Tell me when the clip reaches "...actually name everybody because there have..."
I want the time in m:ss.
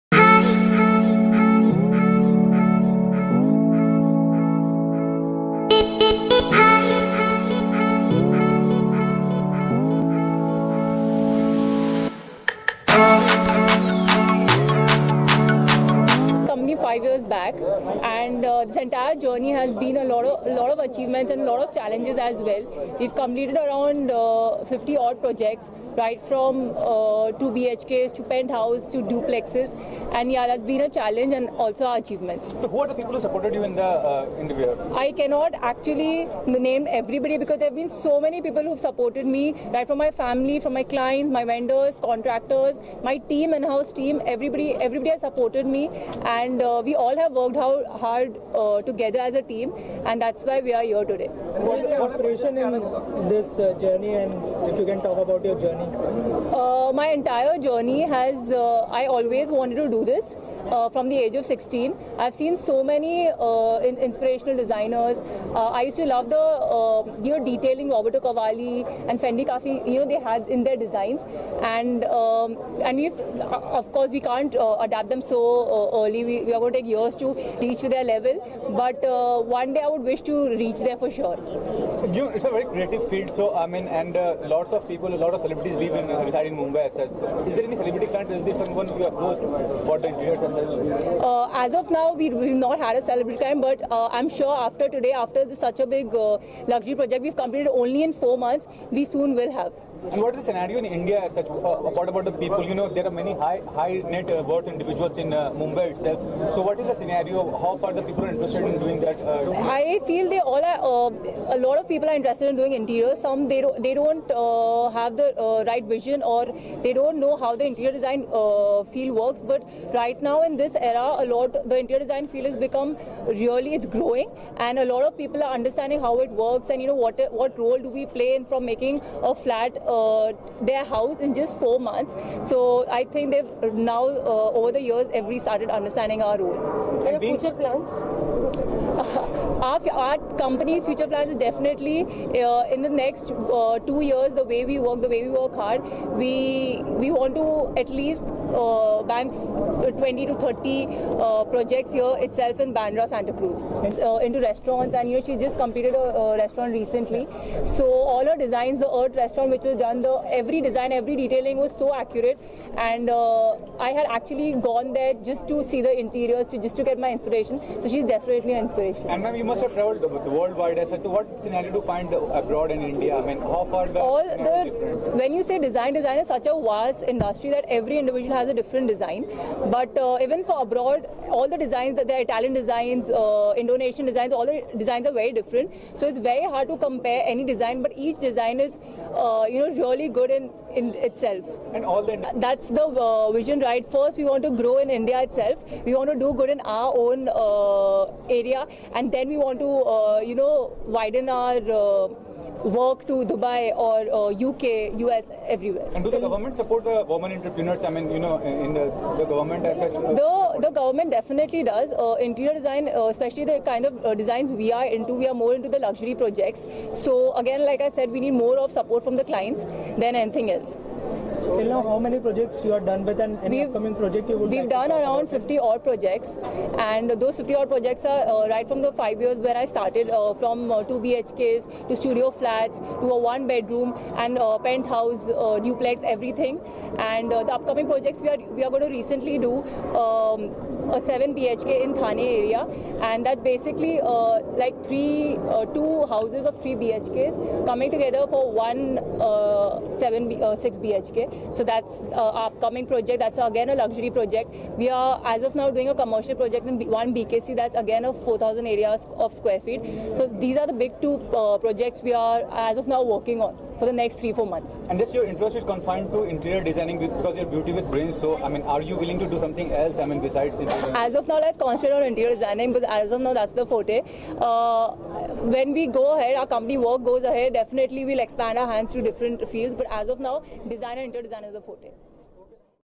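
0:35.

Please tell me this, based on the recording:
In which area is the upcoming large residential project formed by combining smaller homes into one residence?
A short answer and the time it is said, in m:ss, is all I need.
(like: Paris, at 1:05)
Thane, at 4:01.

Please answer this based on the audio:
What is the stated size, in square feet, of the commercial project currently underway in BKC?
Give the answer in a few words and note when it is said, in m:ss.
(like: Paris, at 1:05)
4,000, at 4:18.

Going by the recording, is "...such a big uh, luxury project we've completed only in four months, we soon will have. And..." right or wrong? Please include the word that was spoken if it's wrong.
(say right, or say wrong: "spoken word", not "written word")
right.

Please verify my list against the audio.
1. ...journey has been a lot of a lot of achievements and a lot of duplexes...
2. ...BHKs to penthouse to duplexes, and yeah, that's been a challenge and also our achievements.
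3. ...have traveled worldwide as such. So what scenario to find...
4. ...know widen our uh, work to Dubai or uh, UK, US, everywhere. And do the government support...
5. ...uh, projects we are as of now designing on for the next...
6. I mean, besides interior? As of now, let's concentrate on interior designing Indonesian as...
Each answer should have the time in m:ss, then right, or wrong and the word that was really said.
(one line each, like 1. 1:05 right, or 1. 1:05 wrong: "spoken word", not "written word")
1. 0:19 wrong: "challenges", not "duplexes"
2. 0:27 right
3. 2:49 right
4. 3:20 right
5. 4:21 wrong: "working", not "designing"
6. 4:29 wrong: "But", not "Indonesian".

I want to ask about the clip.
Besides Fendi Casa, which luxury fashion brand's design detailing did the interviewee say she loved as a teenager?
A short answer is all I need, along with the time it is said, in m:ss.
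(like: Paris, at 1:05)
Roberto Cavalli, at 1:07.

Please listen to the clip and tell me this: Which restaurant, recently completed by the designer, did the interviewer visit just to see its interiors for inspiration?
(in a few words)
Earth.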